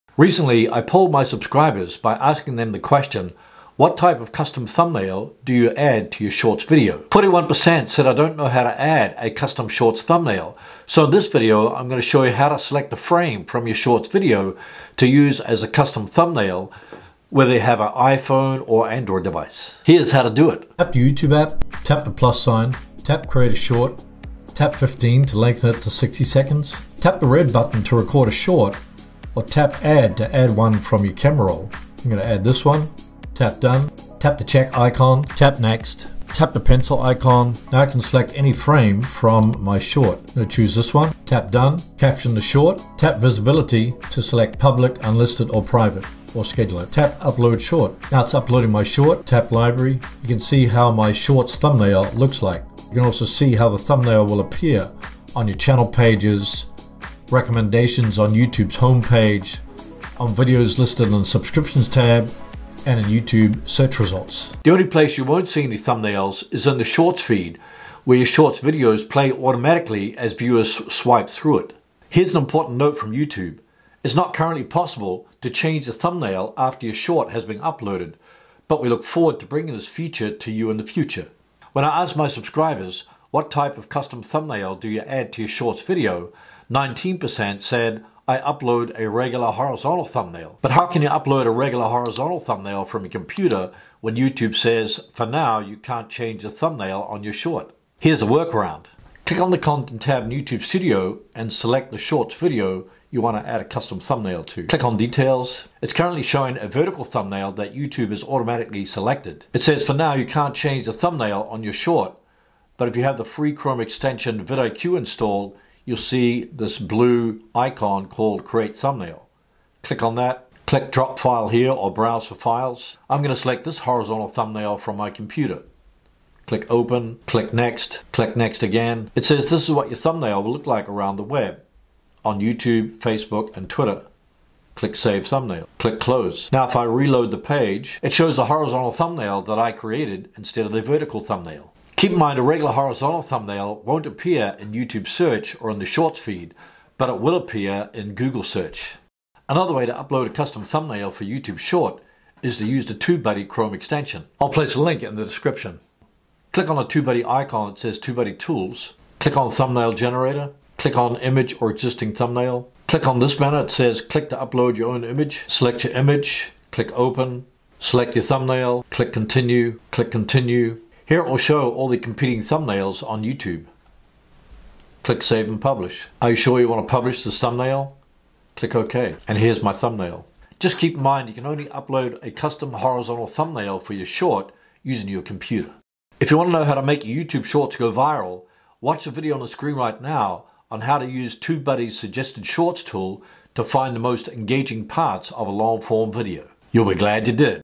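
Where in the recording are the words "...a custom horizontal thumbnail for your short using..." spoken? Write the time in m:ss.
3:02.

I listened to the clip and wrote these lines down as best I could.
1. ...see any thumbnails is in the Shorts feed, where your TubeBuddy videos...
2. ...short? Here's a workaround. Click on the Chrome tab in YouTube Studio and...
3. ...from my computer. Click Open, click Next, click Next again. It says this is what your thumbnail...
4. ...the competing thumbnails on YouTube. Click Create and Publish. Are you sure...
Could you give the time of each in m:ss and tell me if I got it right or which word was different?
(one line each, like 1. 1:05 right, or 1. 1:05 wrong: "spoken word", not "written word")
1. 1:05 wrong: "Shorts", not "TubeBuddy"
2. 1:37 wrong: "Content", not "Chrome"
3. 2:04 right
4. 2:51 wrong: "Save", not "Create".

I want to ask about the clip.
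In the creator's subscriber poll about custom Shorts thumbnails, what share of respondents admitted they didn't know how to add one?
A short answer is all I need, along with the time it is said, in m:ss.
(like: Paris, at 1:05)
41%, at 0:07.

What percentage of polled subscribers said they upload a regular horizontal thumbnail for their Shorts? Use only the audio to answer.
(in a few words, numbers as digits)
19%.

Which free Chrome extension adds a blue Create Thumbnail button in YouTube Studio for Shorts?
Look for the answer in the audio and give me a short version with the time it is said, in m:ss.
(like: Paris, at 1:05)
vidIQ, at 1:54.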